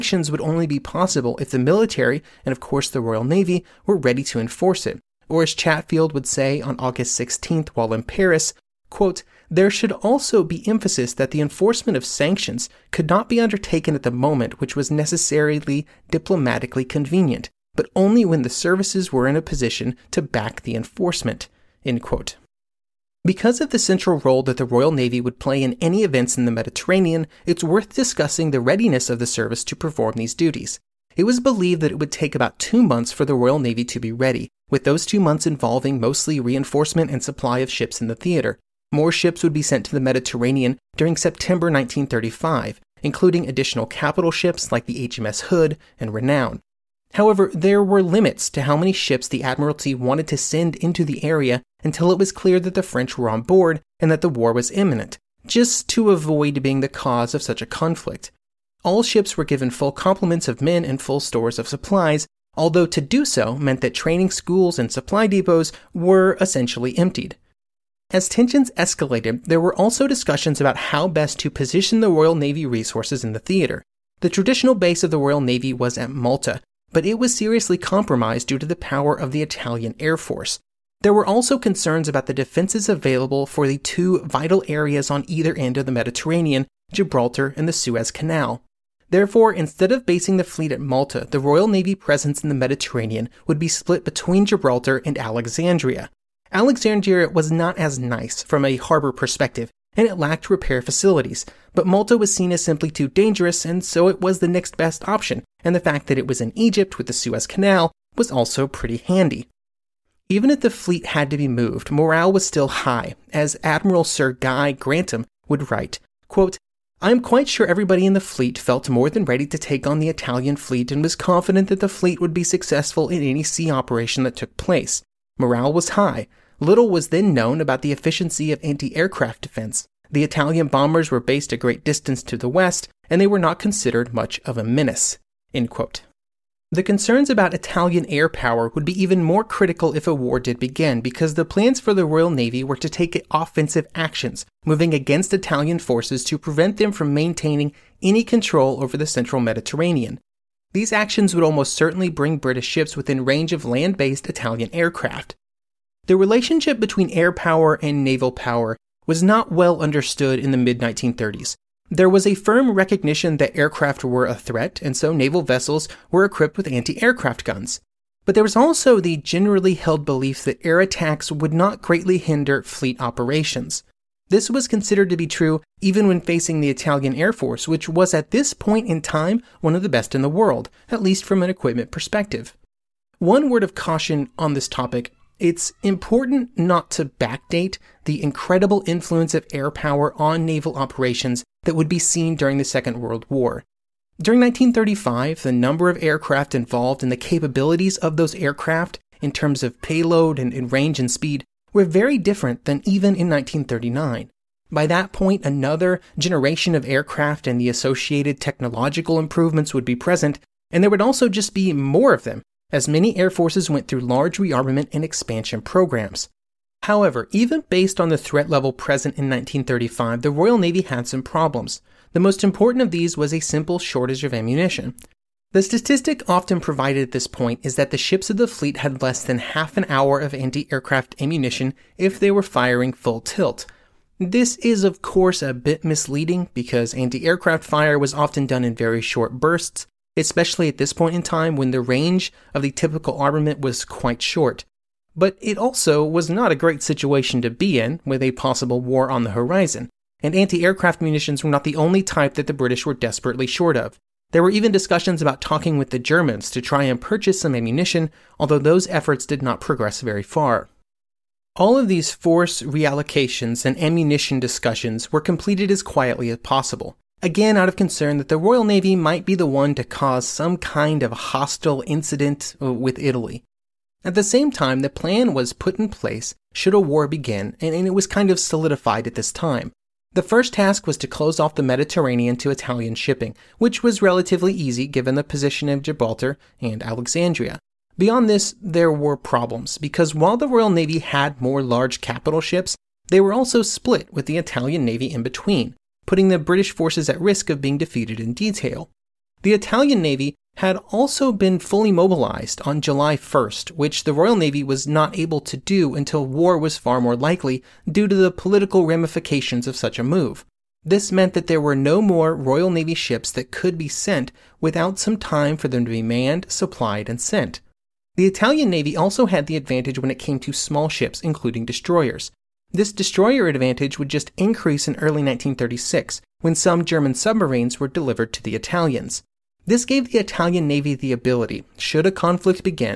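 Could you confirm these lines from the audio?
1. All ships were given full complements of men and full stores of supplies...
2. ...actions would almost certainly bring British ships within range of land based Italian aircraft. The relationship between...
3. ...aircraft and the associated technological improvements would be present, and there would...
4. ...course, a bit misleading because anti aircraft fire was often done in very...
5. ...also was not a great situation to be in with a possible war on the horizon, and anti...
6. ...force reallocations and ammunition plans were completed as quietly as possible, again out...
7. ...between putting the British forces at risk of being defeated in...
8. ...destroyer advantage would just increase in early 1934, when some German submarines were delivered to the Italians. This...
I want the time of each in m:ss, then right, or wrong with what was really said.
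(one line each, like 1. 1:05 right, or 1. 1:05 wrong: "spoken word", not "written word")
1. 0:58 right
2. 2:30 right
3. 3:26 right
4. 3:55 right
5. 4:05 right
6. 4:22 wrong: "discussions", not "plans"
7. 4:55 right
8. 5:22 wrong: "1936", not "1934".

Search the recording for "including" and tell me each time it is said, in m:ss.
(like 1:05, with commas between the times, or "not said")
0:43, 5:21.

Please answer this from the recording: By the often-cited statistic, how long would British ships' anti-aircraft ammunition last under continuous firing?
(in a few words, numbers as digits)
half an hour.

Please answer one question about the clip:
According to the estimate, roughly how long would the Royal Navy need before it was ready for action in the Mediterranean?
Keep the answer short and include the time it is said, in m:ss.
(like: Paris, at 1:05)
2 months, at 0:32.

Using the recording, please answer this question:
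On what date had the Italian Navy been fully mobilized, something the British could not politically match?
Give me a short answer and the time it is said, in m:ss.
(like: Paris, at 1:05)
July 1, at 5:02.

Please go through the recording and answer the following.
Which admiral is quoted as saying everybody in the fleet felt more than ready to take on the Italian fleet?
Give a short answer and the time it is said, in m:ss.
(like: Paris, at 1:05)
Sir Guy Grantham, at 1:54.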